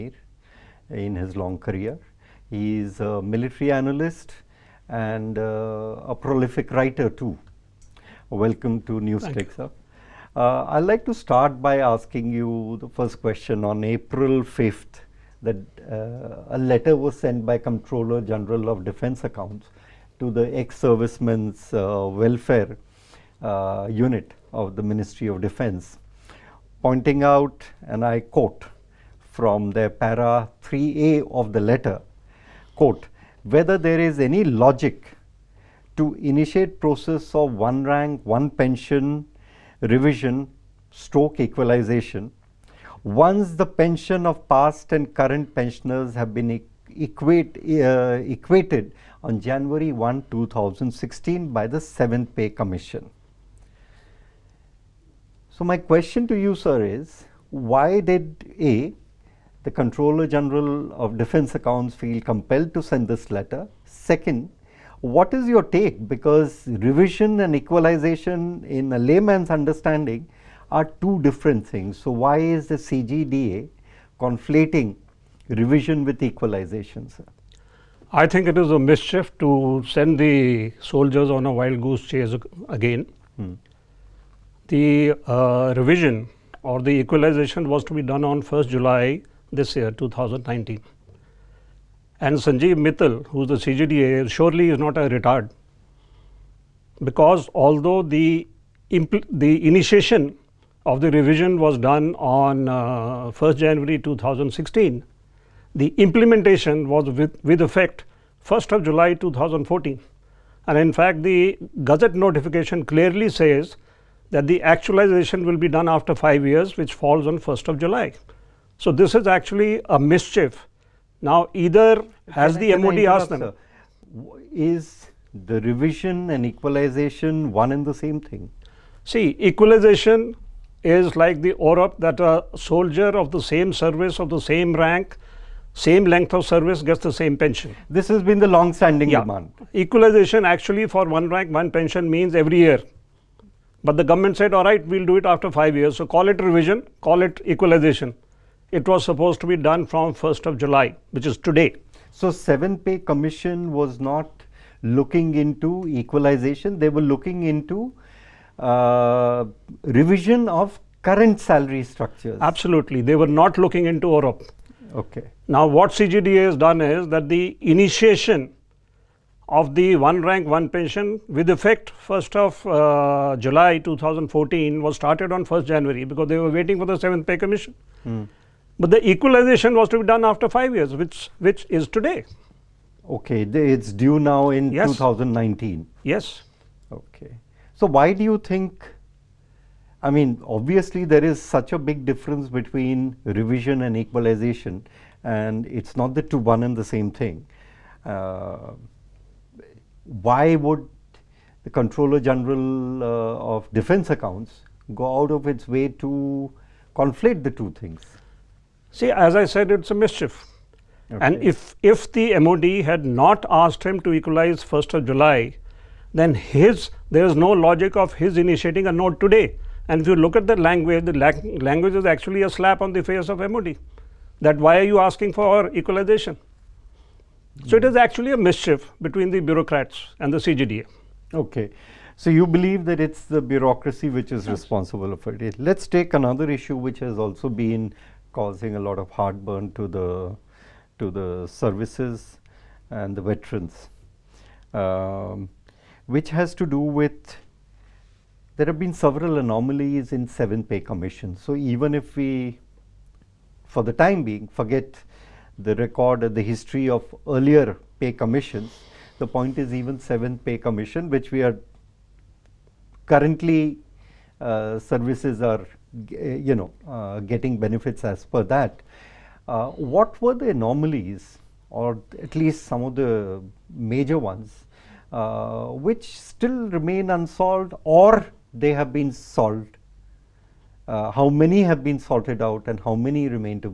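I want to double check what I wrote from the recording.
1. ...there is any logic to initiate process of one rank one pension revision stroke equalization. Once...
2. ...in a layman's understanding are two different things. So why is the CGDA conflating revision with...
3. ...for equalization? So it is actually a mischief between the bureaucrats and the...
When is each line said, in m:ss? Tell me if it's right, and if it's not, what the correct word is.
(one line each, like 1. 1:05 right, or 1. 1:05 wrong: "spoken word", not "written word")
1. 0:33 right
2. 1:08 right
3. 3:45 right.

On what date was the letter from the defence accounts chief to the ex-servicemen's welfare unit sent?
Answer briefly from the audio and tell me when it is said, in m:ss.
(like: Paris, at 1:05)
April 5th, at 0:13.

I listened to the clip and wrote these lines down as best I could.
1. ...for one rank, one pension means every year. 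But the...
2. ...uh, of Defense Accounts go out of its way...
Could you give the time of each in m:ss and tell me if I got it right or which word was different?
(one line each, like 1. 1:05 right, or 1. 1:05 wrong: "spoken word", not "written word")
1. 2:20 right
2. 3:23 right.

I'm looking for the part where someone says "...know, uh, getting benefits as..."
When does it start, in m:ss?
4:26.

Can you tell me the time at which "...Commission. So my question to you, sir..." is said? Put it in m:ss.
0:52.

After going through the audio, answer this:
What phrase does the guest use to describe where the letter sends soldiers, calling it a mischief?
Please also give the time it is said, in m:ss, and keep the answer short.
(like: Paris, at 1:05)
wild goose chase, at 1:21.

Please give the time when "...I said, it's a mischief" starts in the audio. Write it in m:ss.
3:29.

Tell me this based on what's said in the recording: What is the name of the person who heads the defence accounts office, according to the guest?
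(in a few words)
Sanjeev Mittal.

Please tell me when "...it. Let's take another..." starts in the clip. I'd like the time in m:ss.
3:55.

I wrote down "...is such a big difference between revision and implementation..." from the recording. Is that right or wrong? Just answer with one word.
wrong.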